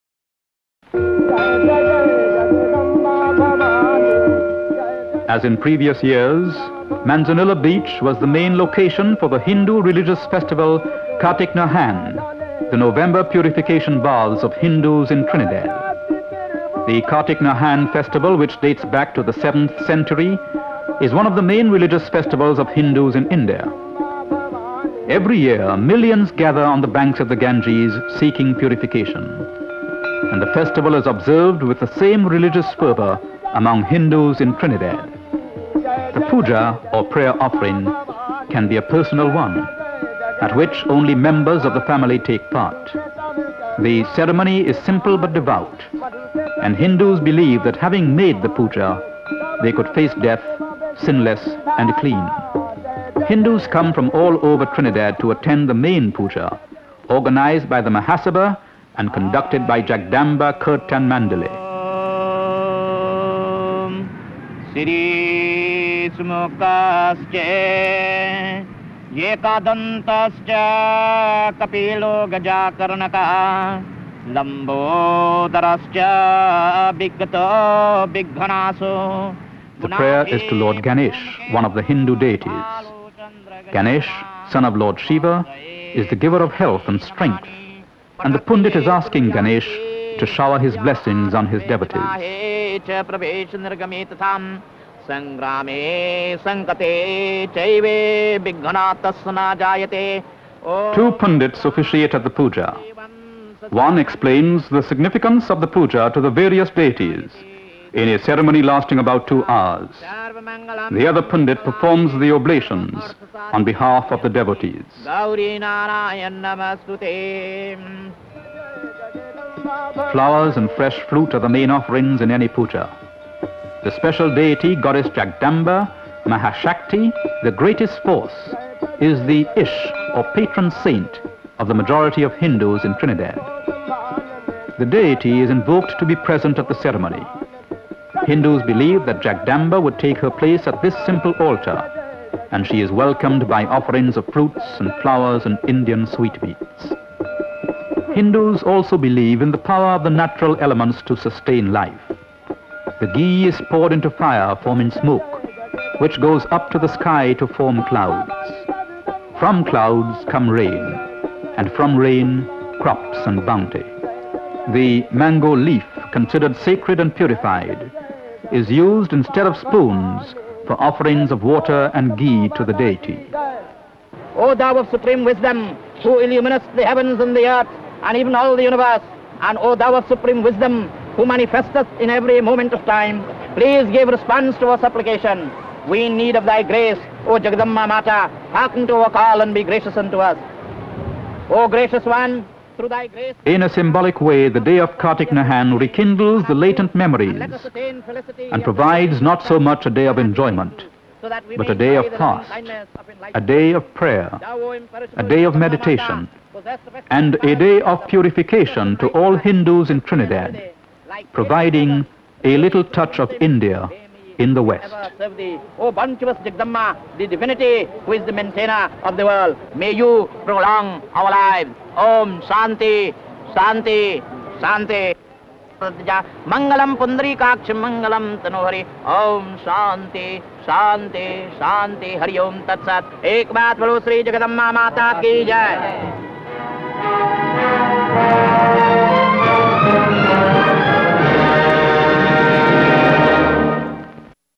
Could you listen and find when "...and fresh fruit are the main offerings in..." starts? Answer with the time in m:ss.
2:00.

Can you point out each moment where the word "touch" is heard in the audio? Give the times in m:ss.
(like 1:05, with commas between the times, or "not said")
3:32.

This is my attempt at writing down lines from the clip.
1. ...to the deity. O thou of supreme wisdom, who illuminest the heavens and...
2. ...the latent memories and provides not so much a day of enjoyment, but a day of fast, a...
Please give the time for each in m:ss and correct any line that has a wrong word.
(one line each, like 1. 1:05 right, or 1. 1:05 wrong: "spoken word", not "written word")
1. 2:52 right
2. 3:16 right.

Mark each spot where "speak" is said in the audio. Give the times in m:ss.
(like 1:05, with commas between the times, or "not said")
not said.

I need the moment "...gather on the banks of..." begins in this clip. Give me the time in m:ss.
0:26.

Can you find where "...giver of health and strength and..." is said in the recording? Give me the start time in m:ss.
1:26.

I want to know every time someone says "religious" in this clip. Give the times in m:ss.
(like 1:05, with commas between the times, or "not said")
0:09, 0:21, 0:32.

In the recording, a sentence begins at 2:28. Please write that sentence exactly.
Hindus also believe in the power of the natural elements to sustain life.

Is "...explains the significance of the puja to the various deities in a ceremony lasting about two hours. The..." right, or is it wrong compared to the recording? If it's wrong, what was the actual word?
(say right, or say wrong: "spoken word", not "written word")
right.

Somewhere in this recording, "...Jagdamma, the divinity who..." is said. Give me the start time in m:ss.
3:36.